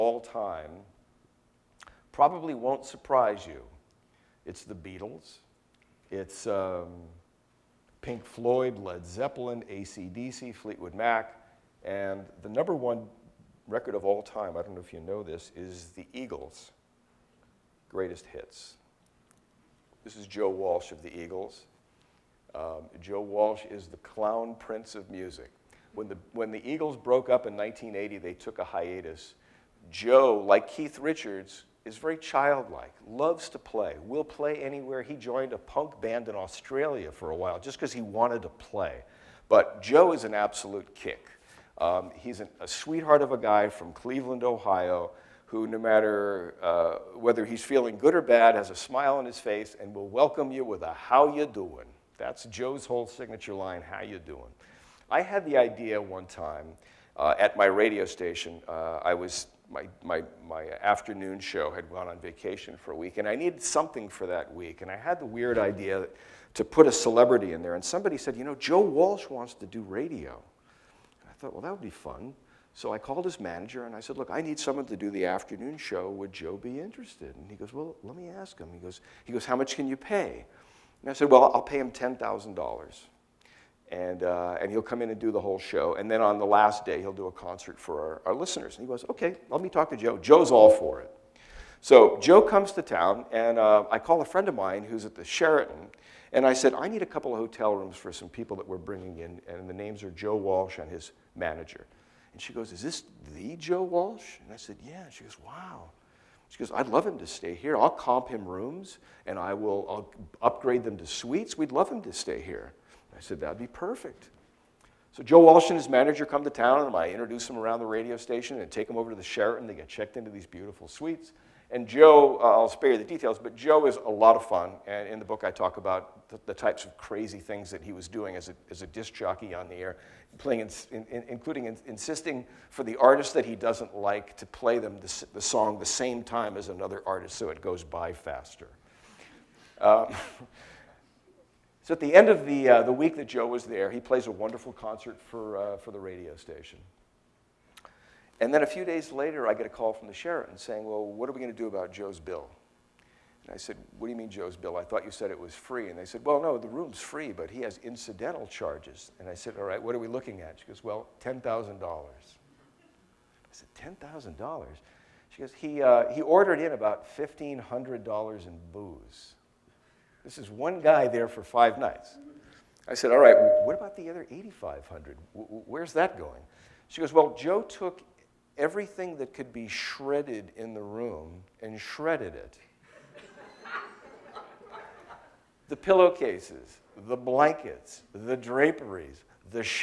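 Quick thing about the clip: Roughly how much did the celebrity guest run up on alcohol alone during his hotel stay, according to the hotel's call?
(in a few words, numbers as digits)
$1,500.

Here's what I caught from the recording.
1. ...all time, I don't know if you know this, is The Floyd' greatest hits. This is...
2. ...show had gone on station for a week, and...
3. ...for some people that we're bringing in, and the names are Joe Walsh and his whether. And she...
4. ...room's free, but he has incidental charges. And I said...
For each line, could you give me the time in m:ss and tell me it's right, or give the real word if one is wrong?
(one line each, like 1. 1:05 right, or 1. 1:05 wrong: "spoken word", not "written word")
1. 0:14 wrong: "Eagles", not "Floyd"
2. 1:01 wrong: "vacation", not "station"
3. 1:37 wrong: "manager", not "whether"
4. 2:36 right.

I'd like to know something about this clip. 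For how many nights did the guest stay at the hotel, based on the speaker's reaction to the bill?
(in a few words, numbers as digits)
5.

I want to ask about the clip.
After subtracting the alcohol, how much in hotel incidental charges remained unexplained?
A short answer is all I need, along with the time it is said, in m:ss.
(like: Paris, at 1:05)
8,500, at 2:54.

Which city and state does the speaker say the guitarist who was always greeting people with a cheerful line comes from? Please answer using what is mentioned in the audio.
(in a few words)
Cleveland, Ohio.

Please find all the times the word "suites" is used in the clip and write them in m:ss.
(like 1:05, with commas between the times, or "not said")
1:51, 2:00.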